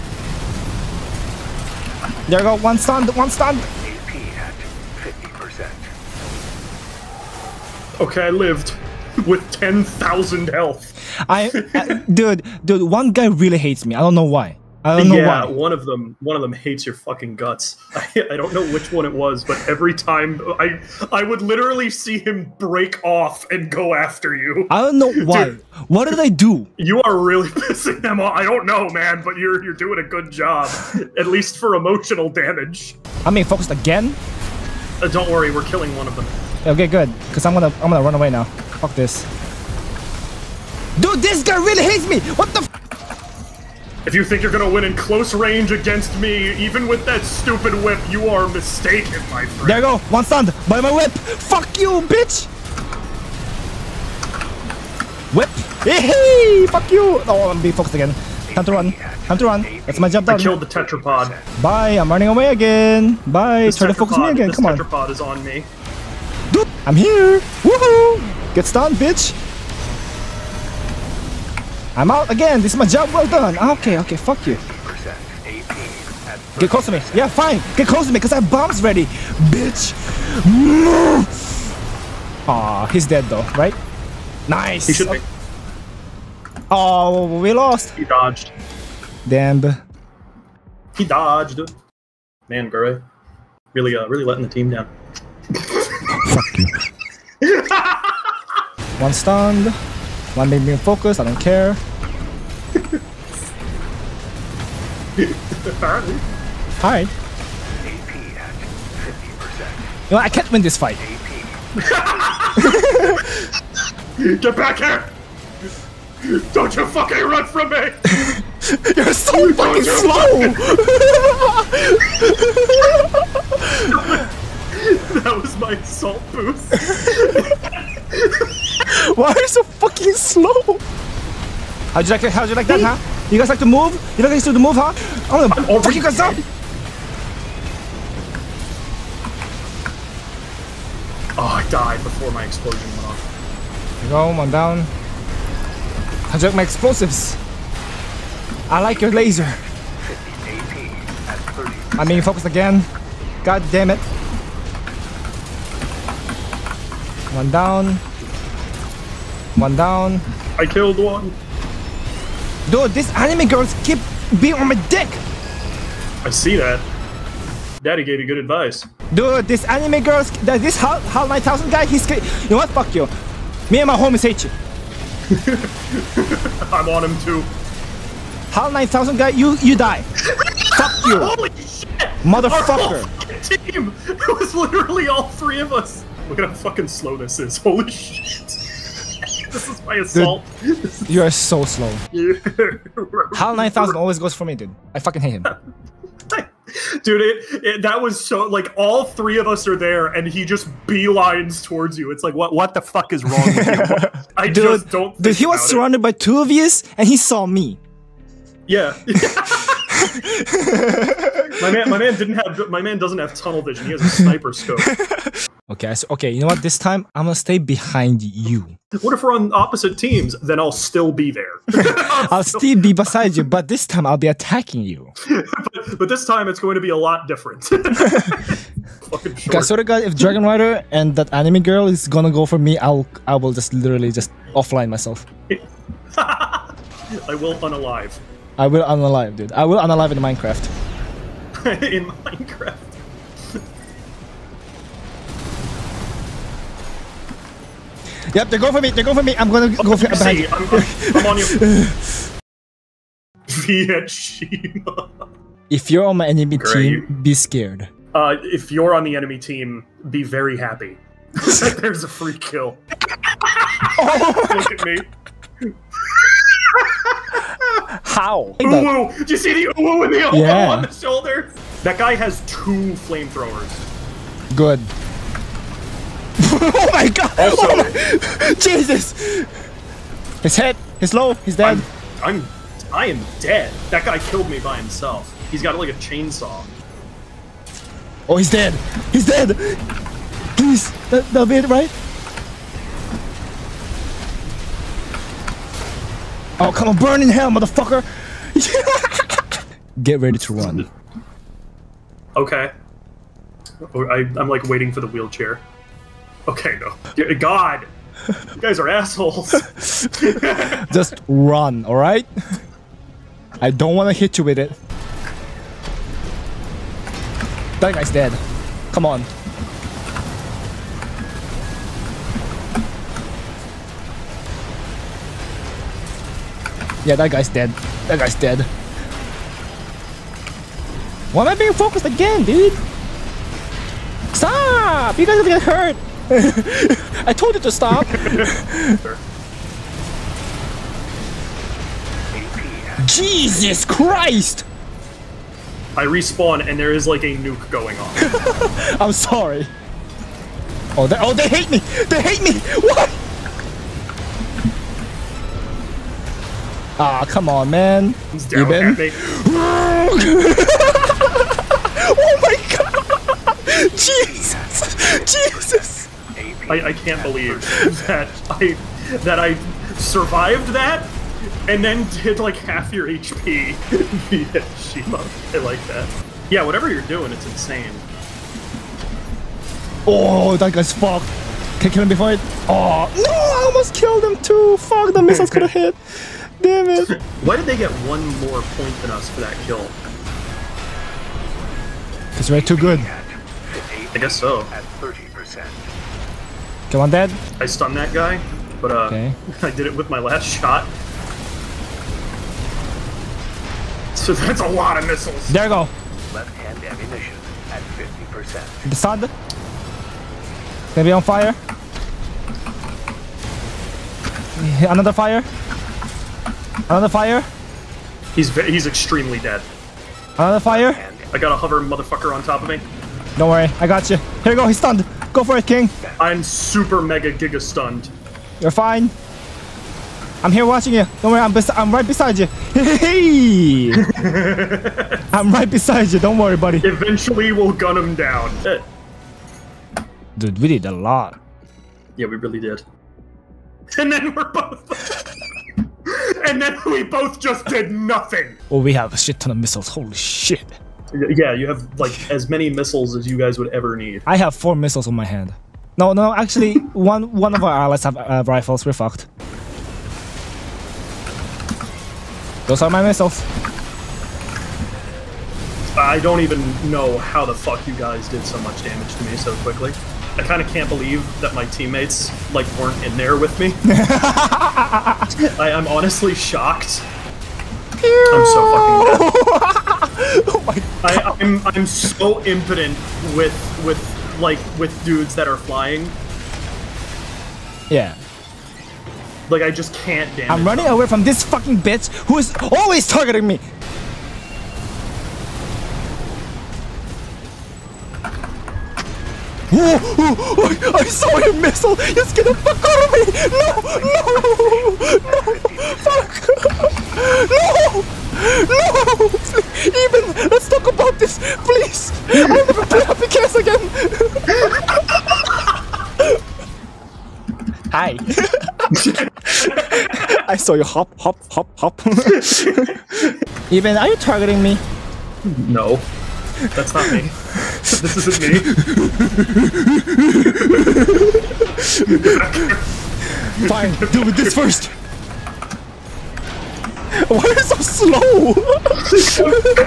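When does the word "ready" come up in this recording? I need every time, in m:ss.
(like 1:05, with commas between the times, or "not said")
1:18, 5:00.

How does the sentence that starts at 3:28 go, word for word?
Yeah my man, my man didn't have.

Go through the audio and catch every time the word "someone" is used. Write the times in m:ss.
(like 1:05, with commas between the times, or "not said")
not said.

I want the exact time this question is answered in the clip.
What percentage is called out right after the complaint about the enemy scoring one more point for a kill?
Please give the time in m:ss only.
6:34.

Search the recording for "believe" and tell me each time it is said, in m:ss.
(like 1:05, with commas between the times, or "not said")
6:07, 7:50.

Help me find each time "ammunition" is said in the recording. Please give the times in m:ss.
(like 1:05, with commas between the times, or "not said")
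6:46.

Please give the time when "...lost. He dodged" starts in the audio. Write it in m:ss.
1:27.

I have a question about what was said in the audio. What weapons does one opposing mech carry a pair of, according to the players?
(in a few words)
Flamethrowers.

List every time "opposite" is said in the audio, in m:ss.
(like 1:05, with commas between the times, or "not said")
3:39.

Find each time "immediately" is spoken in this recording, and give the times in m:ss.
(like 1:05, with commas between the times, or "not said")
not said.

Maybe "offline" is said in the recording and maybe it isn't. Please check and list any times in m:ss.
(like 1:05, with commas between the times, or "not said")
3:54.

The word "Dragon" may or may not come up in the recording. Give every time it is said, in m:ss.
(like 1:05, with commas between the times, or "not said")
3:50.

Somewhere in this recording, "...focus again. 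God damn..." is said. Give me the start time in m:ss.
2:32.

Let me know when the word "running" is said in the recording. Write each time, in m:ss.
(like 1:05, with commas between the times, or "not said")
1:02, 8:10.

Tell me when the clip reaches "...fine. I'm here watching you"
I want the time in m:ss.
7:08.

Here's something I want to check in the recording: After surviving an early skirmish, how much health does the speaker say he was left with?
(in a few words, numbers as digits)
10,000.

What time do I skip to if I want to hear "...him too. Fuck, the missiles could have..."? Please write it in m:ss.
6:24.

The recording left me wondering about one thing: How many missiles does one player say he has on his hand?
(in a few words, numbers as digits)
4.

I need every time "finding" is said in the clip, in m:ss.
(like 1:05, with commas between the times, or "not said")
not said.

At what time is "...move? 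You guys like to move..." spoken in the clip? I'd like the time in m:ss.
2:13.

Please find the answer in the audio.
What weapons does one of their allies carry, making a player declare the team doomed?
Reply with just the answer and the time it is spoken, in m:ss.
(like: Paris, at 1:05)
Rifles, at 7:38.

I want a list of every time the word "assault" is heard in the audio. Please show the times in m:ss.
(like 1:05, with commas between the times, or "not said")
2:05, 3:09.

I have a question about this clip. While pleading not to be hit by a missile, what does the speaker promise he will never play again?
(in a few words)
Happy Case.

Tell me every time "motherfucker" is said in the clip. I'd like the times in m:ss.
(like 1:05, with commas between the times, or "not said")
3:02, 4:57, 7:01.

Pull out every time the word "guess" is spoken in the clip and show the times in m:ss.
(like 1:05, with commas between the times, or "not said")
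6:34.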